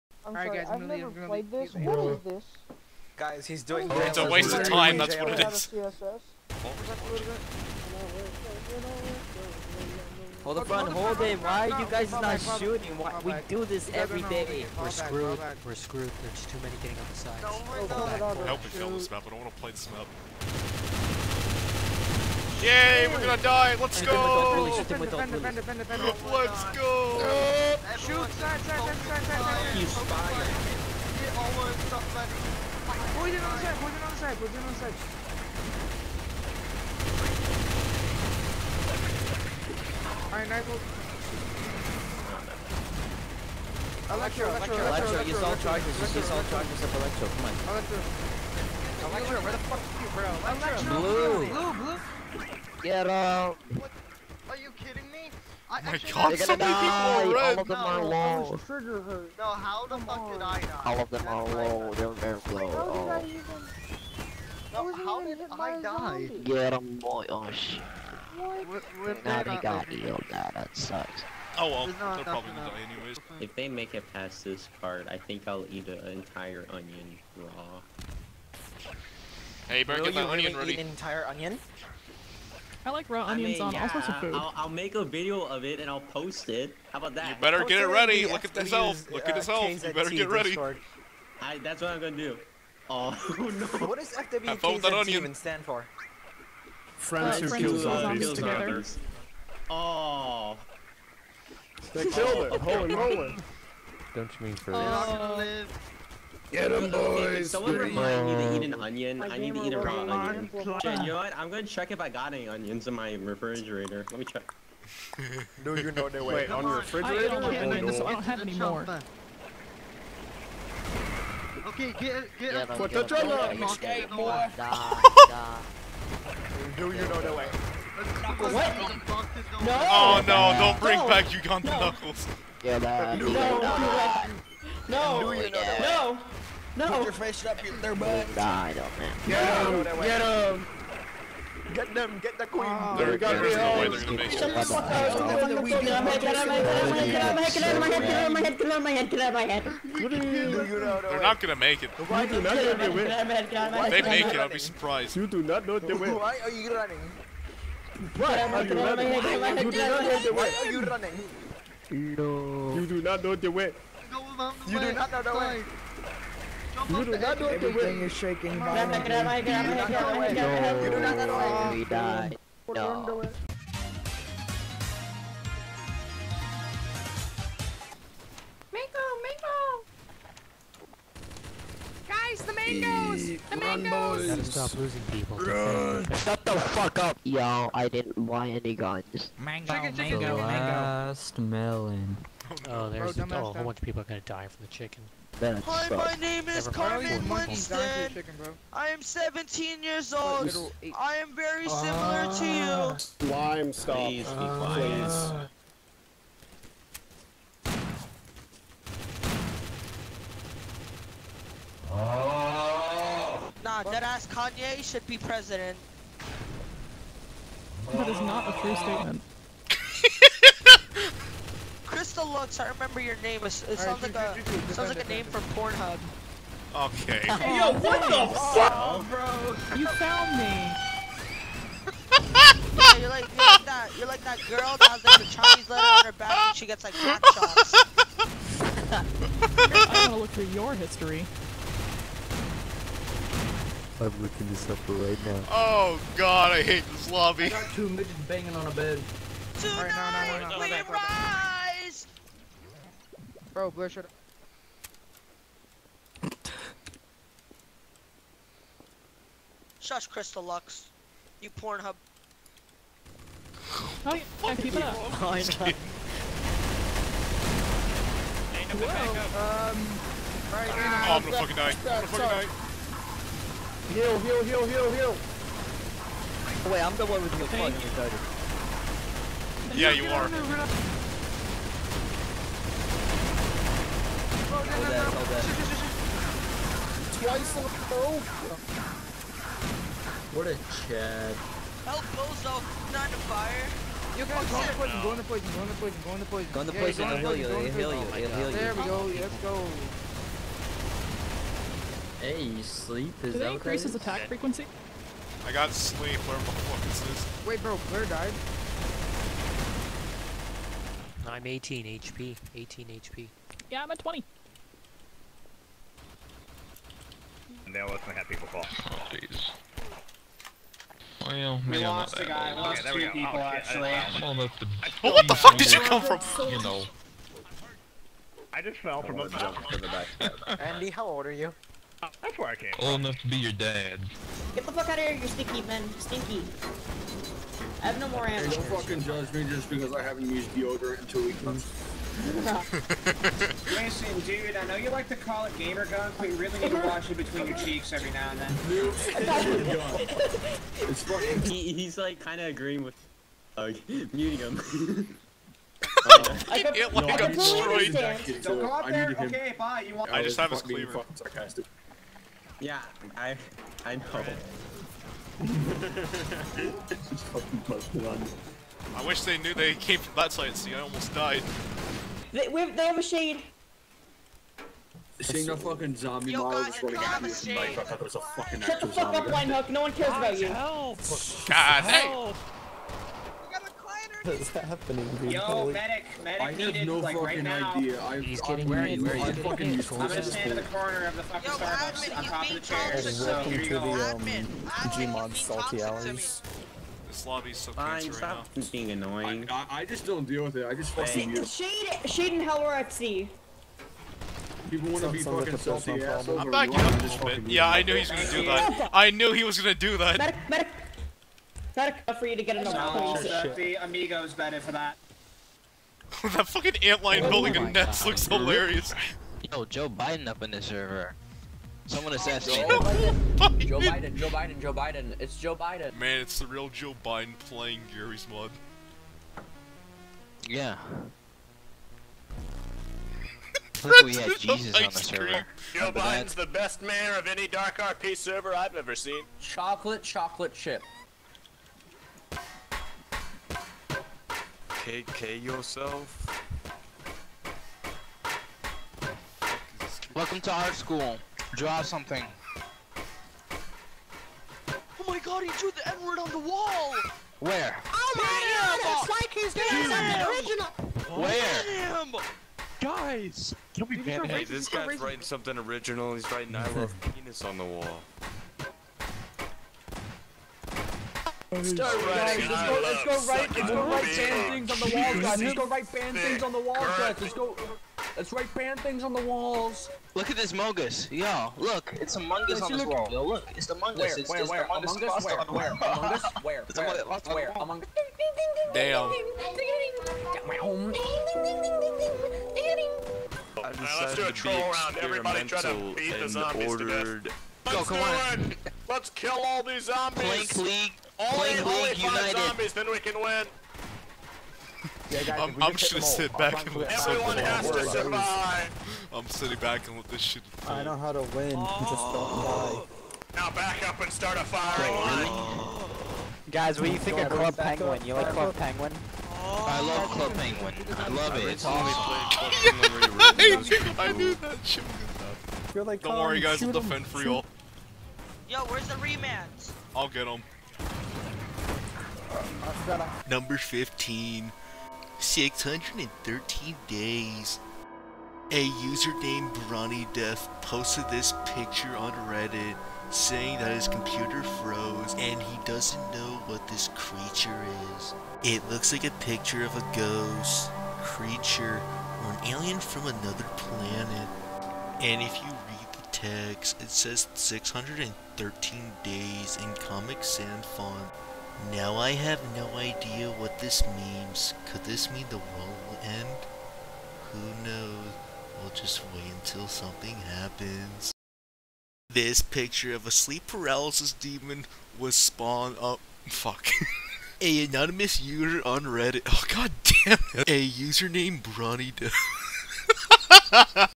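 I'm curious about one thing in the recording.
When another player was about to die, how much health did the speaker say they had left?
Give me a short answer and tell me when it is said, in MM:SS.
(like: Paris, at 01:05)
20, at 05:13.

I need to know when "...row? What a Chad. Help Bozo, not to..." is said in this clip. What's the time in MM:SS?
04:47.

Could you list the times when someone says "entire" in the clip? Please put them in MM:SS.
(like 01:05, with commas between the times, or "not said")
01:16, 01:20.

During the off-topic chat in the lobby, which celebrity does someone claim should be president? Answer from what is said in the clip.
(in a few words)
Kanye.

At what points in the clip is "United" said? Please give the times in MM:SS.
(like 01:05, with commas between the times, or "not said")
08:22.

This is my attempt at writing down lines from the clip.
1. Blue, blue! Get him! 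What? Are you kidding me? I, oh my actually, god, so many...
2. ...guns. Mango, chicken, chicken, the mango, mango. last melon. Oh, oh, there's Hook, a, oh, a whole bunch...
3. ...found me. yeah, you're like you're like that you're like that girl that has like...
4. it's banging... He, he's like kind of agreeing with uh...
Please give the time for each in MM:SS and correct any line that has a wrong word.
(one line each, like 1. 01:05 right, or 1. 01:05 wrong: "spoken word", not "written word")
1. 00:51 right
2. 03:08 wrong: "Bro", not "Hook"
3. 03:49 right
4. 05:50 wrong: "fucking", not "banging".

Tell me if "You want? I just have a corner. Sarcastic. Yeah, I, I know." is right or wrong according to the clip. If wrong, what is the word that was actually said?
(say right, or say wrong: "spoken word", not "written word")
wrong: "cleaver", not "corner".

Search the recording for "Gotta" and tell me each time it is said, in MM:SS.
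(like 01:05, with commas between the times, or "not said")
03:04.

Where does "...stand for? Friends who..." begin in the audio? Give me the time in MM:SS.
01:35.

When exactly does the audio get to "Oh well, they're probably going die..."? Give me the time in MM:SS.
01:11.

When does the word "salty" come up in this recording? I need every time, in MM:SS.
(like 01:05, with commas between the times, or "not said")
06:35, 06:45.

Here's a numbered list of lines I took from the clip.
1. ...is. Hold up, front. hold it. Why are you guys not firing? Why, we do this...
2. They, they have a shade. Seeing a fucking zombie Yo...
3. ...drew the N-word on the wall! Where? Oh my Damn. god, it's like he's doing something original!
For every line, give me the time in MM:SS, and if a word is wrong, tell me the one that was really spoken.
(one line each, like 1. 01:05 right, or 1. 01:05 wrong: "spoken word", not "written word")
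1. 00:05 wrong: "shooting", not "firing"
2. 06:12 right
3. 07:35 right.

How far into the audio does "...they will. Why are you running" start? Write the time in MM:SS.
02:35.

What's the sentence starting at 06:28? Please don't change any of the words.
I've, he's I'm getting where he's I'm fucking useless.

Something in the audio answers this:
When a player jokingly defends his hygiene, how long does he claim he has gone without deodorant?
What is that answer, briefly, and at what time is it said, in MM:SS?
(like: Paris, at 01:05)
2 weeks, at 05:41.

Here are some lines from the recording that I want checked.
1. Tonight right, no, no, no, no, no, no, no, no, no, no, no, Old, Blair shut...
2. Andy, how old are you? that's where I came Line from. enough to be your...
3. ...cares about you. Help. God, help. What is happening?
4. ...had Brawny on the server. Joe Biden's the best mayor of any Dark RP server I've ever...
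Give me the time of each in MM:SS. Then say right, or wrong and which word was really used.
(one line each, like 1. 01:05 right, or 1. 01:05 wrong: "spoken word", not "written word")
1. 04:09 wrong: "Bro", not "Old"
2. 05:30 wrong: "Old", not "Line"
3. 06:19 right
4. 07:14 wrong: "Jesus", not "Brawny".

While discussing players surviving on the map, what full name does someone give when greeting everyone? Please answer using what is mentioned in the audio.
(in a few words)
Carmen Winston.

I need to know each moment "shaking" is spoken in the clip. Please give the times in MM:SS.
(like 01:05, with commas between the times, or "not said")
02:48.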